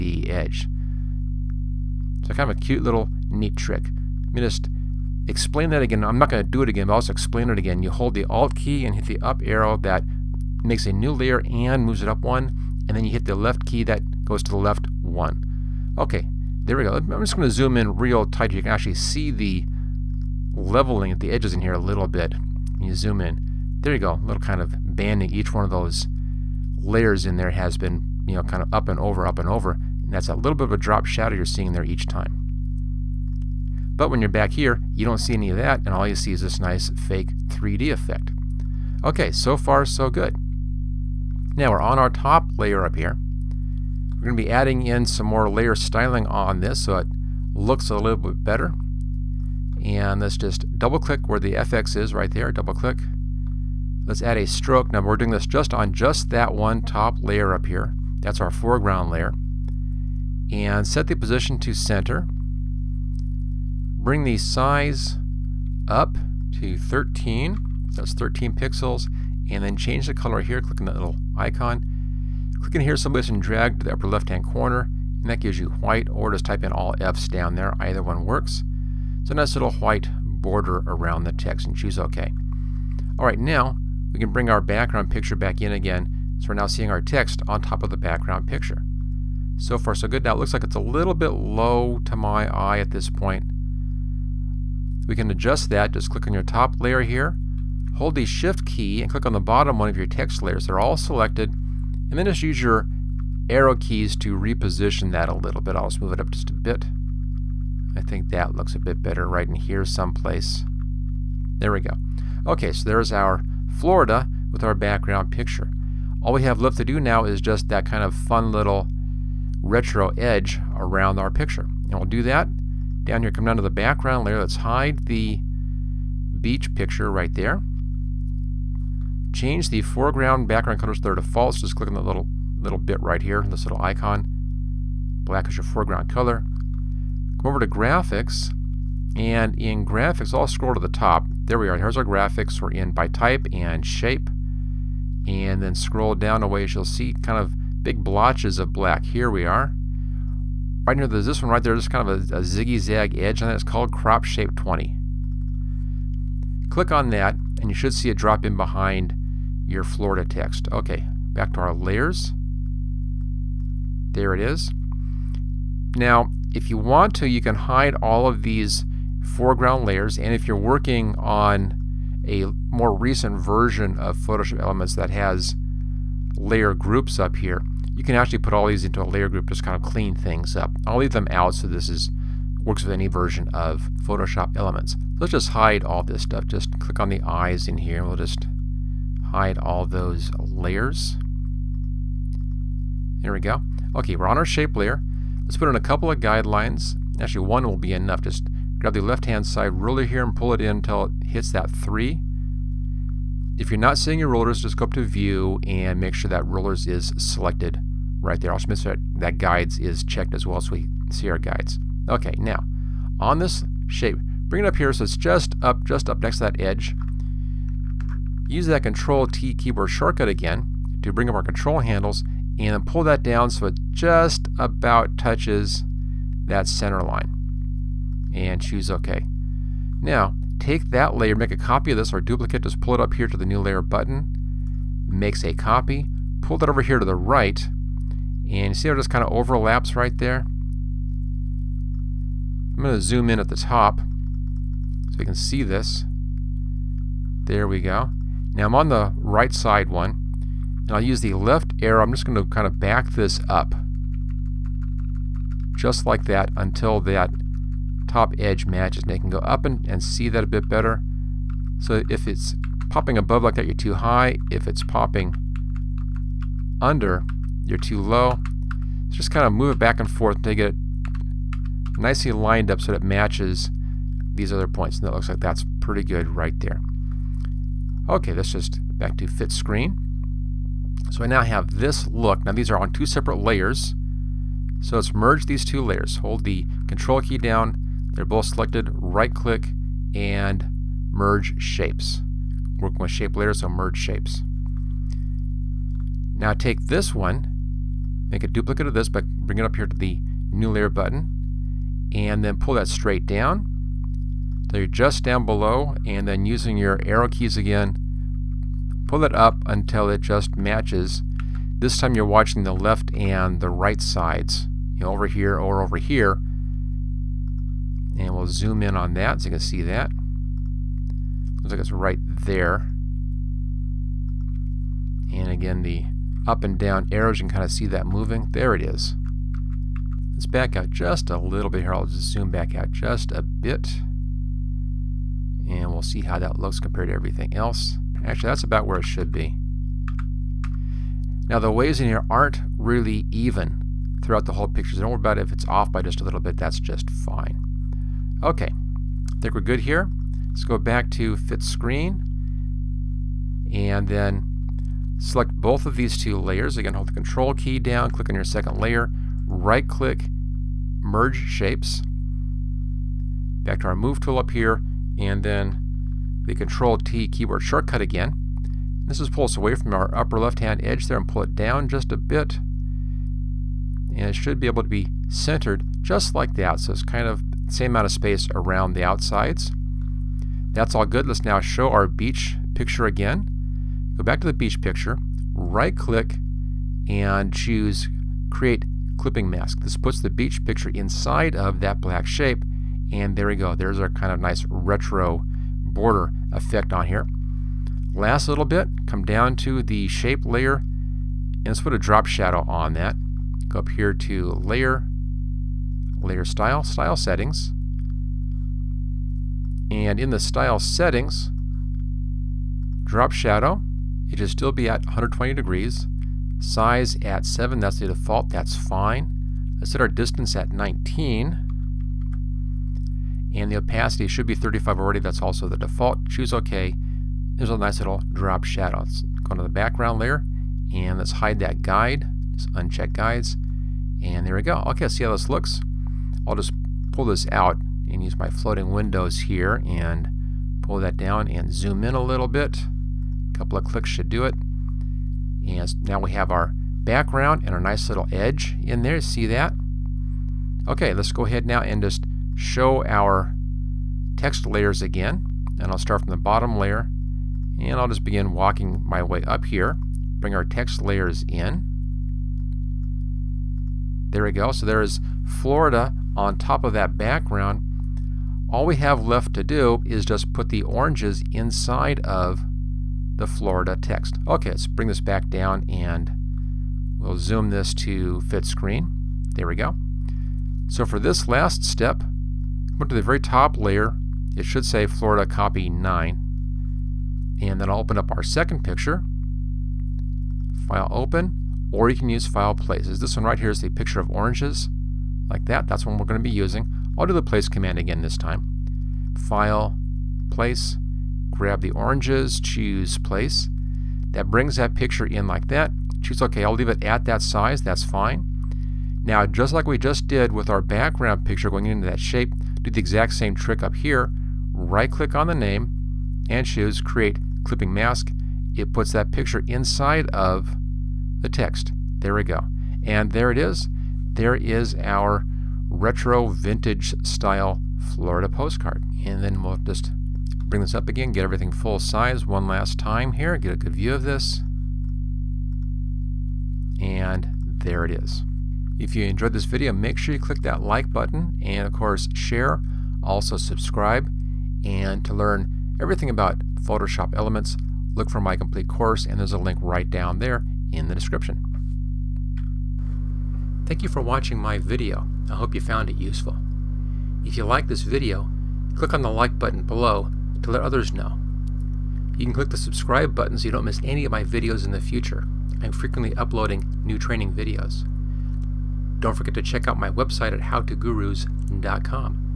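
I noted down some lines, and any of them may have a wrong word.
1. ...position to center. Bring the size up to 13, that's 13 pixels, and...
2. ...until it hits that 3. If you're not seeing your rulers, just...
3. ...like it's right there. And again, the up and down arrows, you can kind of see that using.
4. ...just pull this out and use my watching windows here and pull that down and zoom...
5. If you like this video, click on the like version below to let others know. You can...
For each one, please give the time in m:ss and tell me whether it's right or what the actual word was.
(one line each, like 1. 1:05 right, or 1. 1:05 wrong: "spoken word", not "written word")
1. 1:01 right
2. 3:20 right
3. 5:21 wrong: "moving", not "using"
4. 7:16 wrong: "floating", not "watching"
5. 9:17 wrong: "button", not "version".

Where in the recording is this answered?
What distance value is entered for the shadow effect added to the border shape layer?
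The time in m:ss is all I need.
7:00.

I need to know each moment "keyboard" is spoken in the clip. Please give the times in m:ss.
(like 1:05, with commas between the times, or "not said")
3:39, 6:07.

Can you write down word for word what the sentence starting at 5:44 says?
So don't worry about it if it's off by just a little bit.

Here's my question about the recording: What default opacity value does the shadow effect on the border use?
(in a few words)
35.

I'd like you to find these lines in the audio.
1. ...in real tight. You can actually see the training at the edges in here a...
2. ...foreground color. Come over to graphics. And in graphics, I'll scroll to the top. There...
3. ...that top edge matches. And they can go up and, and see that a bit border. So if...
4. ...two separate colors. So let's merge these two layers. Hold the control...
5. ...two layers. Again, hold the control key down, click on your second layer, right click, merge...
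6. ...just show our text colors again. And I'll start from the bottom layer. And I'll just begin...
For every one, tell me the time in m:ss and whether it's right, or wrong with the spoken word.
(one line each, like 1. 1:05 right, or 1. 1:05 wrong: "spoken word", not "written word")
1. 0:17 wrong: "leveling", not "training"
2. 2:15 right
3. 4:16 wrong: "better", not "border"
4. 4:42 wrong: "layers", not "colors"
5. 5:56 right
6. 7:32 wrong: "layers", not "colors".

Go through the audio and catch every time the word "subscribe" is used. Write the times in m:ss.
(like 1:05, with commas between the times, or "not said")
9:03, 9:22.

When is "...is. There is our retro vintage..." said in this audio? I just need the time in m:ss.
8:43.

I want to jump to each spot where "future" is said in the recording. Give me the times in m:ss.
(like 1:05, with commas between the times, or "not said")
9:24.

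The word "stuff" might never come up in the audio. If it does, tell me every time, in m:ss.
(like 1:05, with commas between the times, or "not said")
3:06.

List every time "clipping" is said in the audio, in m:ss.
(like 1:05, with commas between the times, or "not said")
6:29, 8:37.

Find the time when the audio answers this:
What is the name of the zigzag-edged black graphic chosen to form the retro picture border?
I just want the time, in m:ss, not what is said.
2:33.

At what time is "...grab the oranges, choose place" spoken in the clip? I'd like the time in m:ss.
8:21.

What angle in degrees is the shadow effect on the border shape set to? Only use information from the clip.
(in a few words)
120.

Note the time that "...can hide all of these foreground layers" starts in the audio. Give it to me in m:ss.
2:47.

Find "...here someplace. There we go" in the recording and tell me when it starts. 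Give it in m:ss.
1:49.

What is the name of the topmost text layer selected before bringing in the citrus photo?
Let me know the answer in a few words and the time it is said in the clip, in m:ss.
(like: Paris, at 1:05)
Florida copy 9, at 8:05.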